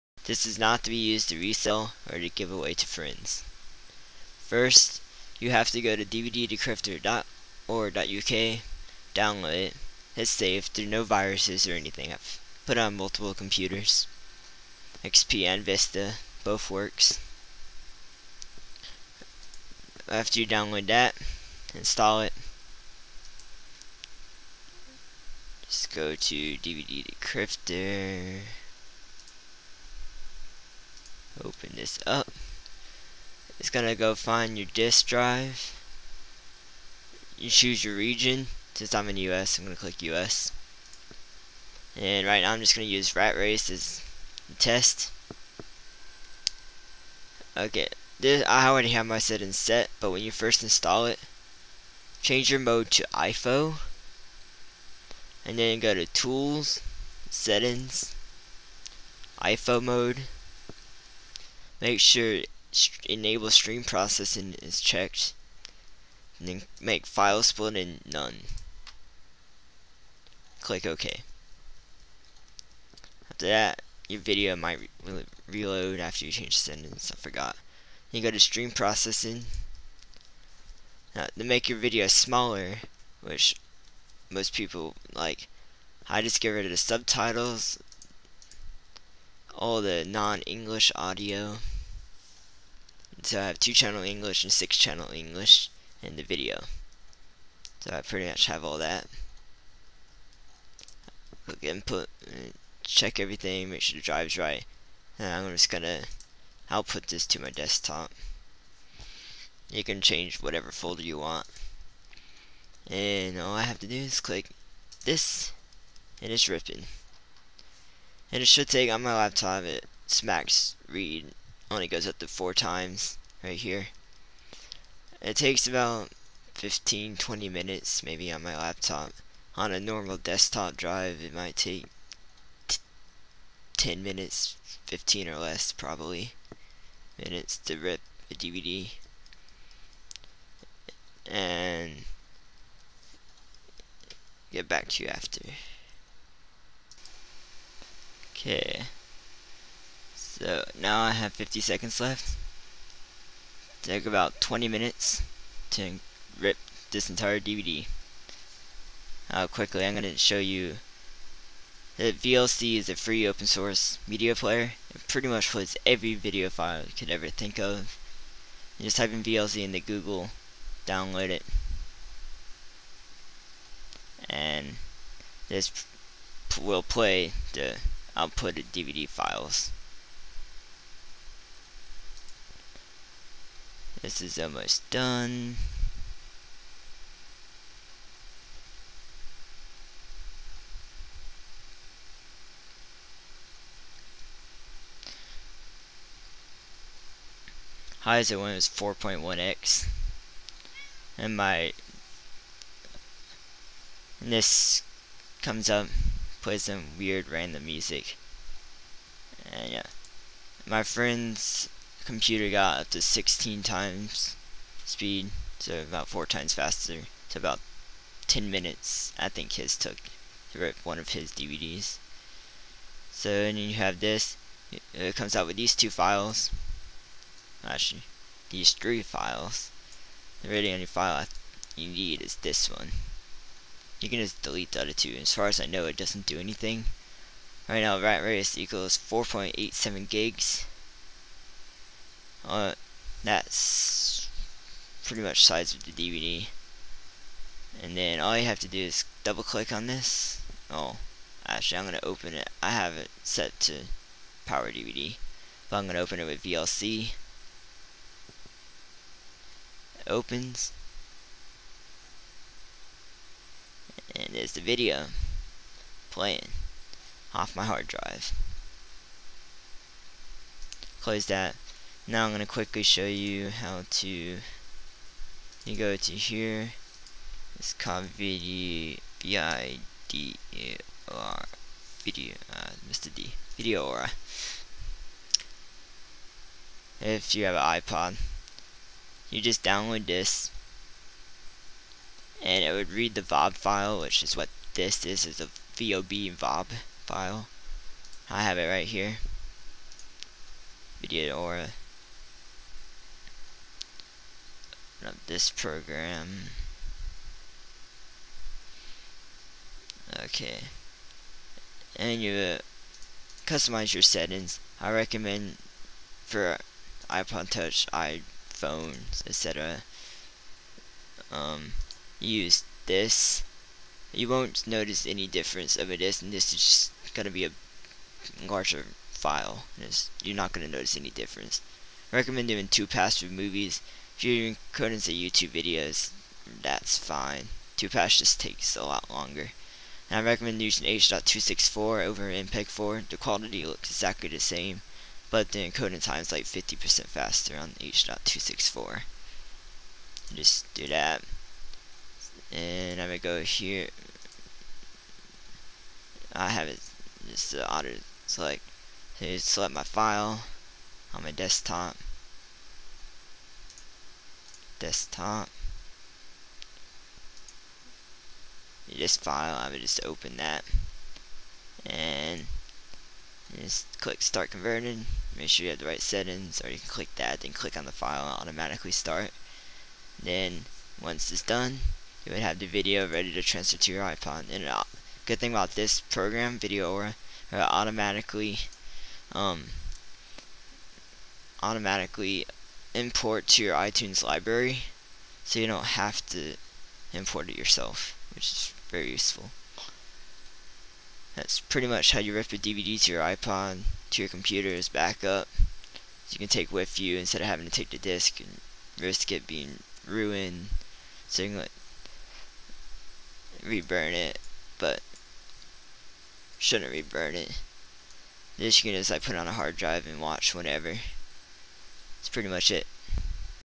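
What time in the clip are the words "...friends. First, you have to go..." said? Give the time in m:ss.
0:02.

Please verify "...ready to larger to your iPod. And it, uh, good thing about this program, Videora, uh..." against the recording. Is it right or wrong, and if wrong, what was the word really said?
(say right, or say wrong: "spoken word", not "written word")
wrong: "transfer", not "larger".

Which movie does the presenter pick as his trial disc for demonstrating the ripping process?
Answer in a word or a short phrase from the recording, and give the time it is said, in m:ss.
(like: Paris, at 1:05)
Rat Race, at 0:43.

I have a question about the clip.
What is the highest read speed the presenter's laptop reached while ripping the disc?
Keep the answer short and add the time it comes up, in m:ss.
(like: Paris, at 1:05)
4.1x, at 3:18.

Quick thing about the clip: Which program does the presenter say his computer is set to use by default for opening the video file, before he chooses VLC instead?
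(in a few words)
Power DVD.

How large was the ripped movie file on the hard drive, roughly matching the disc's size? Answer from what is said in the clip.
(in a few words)
4.87 gigs.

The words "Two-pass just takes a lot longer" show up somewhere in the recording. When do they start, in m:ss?
5:37.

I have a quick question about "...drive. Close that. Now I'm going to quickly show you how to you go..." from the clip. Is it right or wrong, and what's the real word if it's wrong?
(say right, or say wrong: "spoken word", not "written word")
right.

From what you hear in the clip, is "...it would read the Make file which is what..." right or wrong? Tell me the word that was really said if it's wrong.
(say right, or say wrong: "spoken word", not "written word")
wrong: "VOB", not "Make".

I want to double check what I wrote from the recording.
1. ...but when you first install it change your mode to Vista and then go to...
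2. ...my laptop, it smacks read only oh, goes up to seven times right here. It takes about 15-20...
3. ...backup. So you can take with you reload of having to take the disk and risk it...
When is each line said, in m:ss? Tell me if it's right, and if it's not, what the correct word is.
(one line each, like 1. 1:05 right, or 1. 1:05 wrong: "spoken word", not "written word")
1. 0:49 wrong: "IFO", not "Vista"
2. 1:59 wrong: "four", not "seven"
3. 6:44 wrong: "instead", not "reload".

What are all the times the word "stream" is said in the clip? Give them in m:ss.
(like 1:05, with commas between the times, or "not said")
1:03, 1:18.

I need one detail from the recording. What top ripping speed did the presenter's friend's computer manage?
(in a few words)
16 times.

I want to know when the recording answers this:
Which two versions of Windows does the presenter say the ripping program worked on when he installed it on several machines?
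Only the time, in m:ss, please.
0:15.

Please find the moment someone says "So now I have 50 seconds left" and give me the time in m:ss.
2:30.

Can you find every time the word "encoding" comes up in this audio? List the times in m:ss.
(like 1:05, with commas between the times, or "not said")
5:45.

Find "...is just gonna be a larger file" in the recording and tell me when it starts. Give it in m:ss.
5:26.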